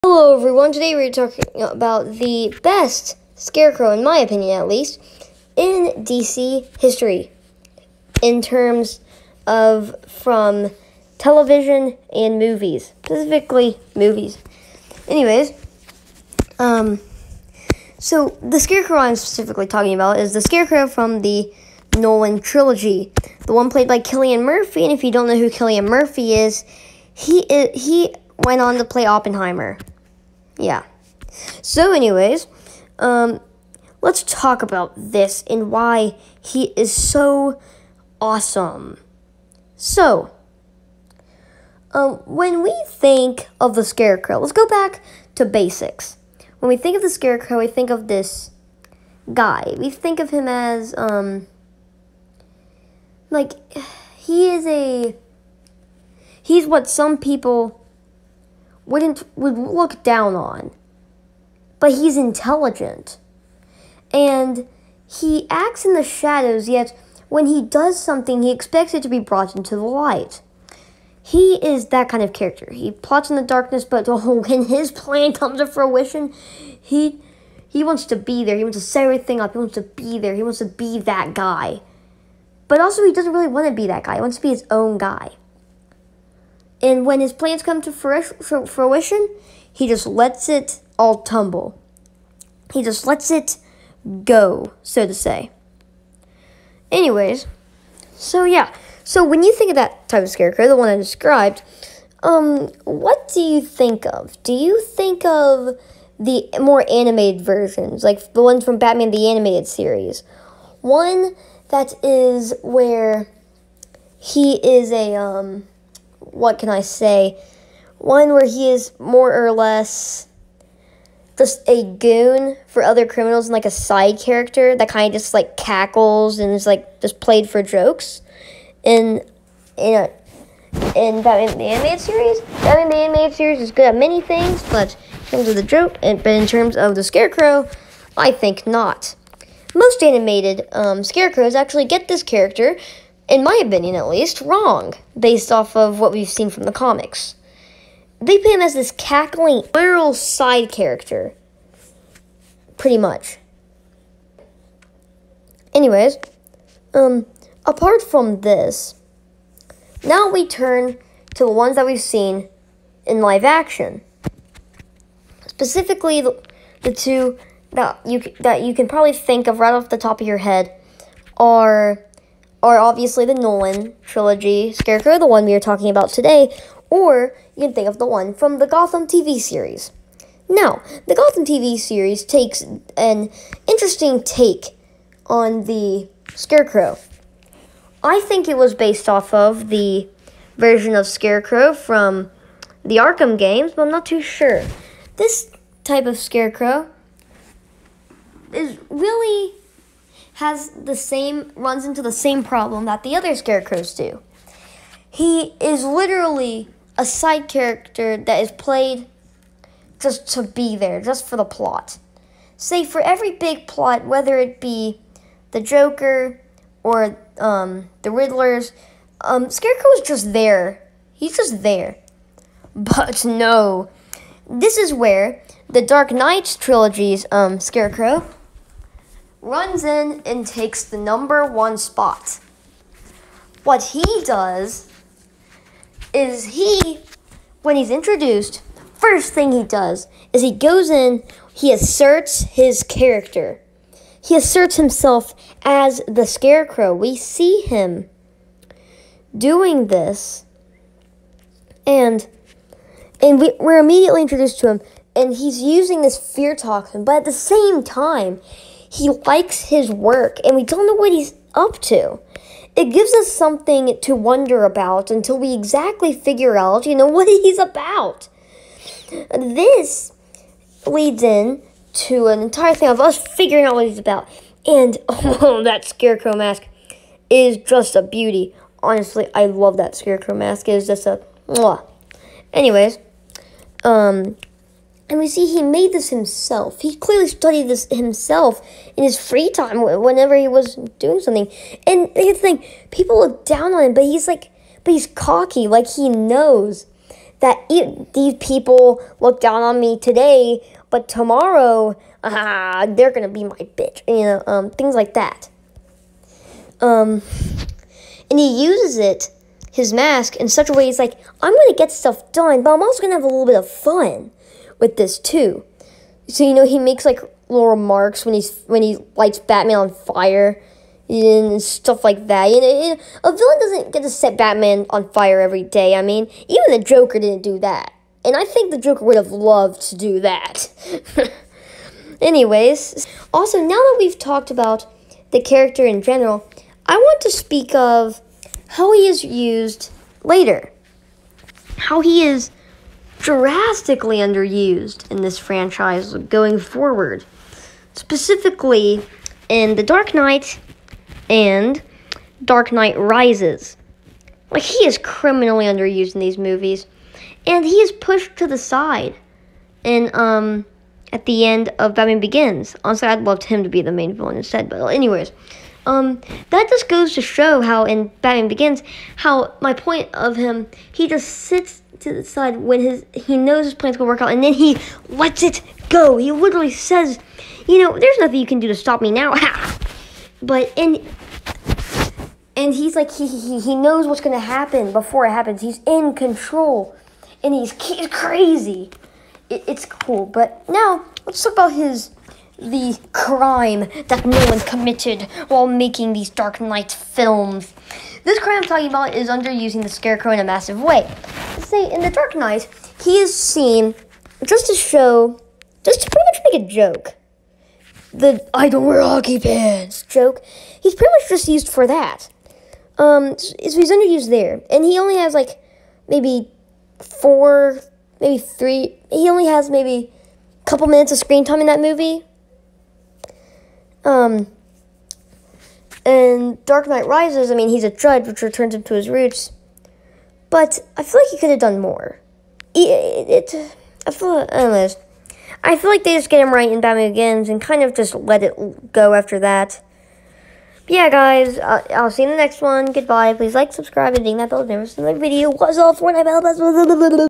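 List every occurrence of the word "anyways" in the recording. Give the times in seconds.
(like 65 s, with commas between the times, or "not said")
15 s, 31 s, 96 s, 155 s, 282 s, 332 s, 364 s, 434 s.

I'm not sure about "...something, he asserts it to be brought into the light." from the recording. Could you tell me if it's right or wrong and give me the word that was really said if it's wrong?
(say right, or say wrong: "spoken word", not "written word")
wrong: "expects", not "asserts".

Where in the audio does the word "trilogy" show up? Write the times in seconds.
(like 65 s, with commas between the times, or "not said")
22 s, 174 s, 226 s.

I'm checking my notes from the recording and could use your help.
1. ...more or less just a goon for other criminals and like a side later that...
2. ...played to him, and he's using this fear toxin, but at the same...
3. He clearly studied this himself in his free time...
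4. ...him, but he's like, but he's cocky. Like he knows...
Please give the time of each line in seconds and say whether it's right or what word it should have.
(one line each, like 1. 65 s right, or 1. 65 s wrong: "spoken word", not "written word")
1. 118 s wrong: "character", not "later"
2. 254 s wrong: "introduced", not "played"
3. 286 s right
4. 293 s right.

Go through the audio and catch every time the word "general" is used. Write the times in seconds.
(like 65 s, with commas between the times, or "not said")
336 s.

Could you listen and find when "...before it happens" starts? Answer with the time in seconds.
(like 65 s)
384 s.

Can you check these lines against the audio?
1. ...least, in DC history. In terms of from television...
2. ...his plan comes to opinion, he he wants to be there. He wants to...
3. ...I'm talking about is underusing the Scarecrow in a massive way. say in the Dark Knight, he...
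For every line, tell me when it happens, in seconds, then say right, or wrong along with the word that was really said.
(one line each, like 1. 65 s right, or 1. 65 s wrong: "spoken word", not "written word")
1. 4 s right
2. 74 s wrong: "fruition", not "opinion"
3. 398 s right.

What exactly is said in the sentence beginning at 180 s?
Now, the Gotham TV series takes an interesting take on the Scarecrow.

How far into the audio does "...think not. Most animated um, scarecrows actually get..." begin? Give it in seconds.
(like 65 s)
138 s.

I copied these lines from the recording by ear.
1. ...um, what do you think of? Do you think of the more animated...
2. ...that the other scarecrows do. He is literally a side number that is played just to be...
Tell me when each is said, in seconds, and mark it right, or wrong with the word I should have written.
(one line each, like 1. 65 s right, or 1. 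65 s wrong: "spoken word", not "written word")
1. 102 s right
2. 202 s wrong: "character", not "number".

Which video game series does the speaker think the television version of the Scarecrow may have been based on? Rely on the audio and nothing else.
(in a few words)
Arkham games.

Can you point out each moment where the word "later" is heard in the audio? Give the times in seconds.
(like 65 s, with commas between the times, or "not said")
340 s.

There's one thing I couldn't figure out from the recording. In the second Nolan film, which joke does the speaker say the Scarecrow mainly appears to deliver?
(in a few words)
I don't wear hockey pants.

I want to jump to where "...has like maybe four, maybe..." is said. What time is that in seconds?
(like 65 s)
415 s.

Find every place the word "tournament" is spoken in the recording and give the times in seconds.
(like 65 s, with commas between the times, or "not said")
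not said.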